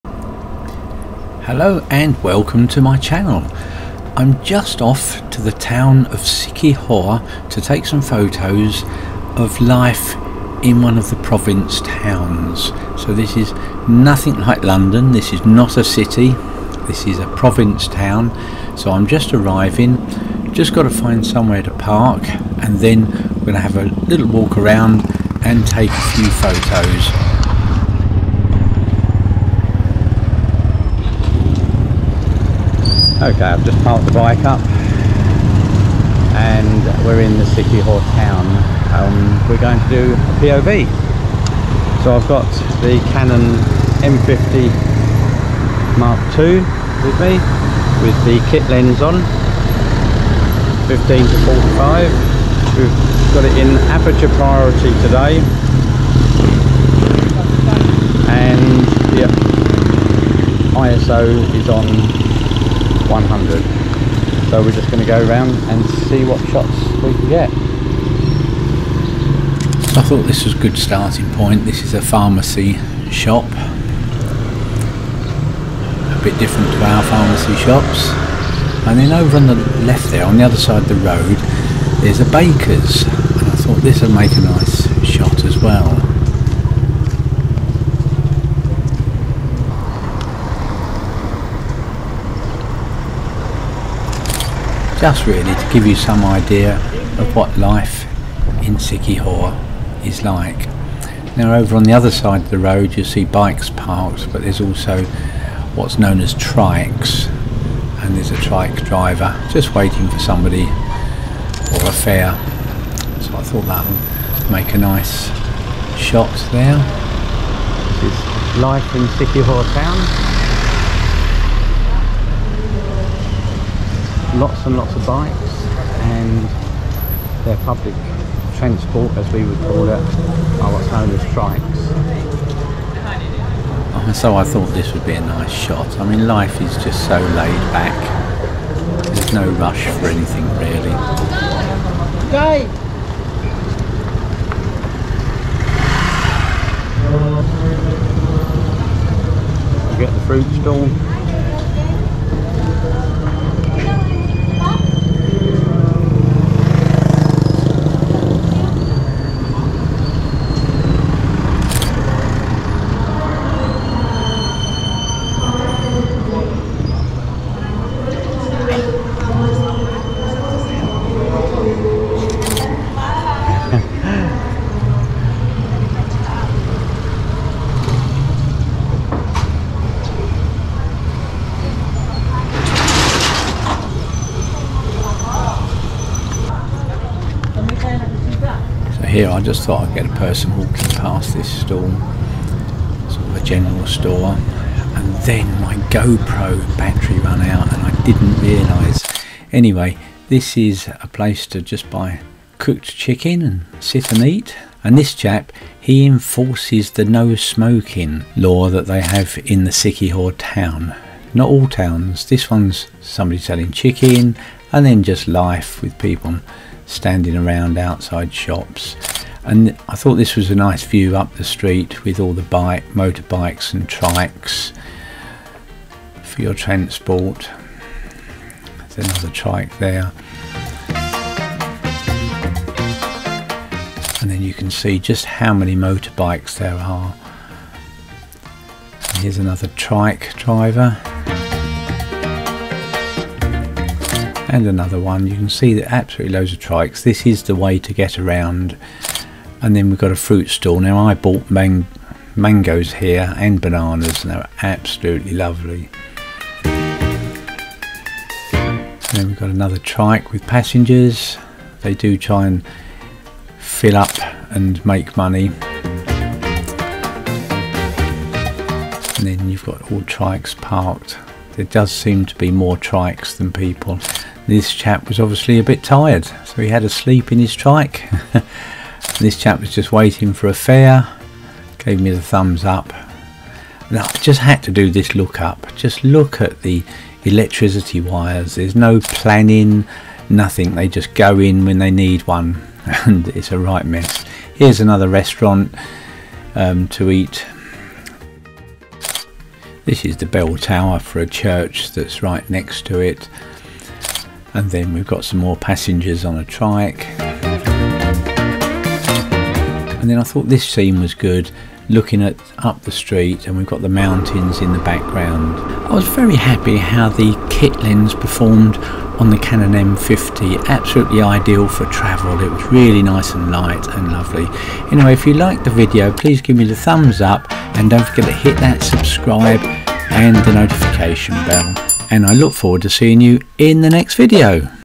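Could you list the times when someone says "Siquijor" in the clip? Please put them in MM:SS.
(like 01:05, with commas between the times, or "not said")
00:06, 01:38, 01:59, 03:29.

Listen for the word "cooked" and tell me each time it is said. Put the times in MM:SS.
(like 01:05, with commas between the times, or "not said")
03:22.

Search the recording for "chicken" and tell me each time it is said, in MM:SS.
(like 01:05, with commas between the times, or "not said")
03:22, 03:33.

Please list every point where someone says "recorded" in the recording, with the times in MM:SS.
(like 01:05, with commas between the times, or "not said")
not said.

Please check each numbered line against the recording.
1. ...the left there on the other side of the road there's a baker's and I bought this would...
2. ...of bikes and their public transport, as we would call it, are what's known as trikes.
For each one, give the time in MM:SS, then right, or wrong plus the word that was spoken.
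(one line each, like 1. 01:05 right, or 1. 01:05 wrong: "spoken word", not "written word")
1. 01:19 wrong: "thought", not "bought"
2. 02:04 right.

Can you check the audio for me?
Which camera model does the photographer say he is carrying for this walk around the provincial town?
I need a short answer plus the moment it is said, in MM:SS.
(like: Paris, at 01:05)
Canon M50 Mark II, at 00:43.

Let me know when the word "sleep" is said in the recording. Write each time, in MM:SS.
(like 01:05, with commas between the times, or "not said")
04:36.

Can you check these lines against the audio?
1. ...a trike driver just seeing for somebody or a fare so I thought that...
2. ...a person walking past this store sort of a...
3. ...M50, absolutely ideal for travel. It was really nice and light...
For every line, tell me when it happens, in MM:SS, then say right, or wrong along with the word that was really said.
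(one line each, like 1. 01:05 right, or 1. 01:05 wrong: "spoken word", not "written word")
1. 01:48 wrong: "waiting", not "seeing"
2. 03:10 right
3. 05:19 right.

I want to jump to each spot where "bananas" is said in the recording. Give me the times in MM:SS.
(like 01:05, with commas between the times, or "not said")
04:13.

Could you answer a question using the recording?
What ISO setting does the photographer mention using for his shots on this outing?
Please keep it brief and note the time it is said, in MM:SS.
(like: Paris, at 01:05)
100, at 01:03.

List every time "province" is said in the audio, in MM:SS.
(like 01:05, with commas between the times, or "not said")
00:11, 00:17.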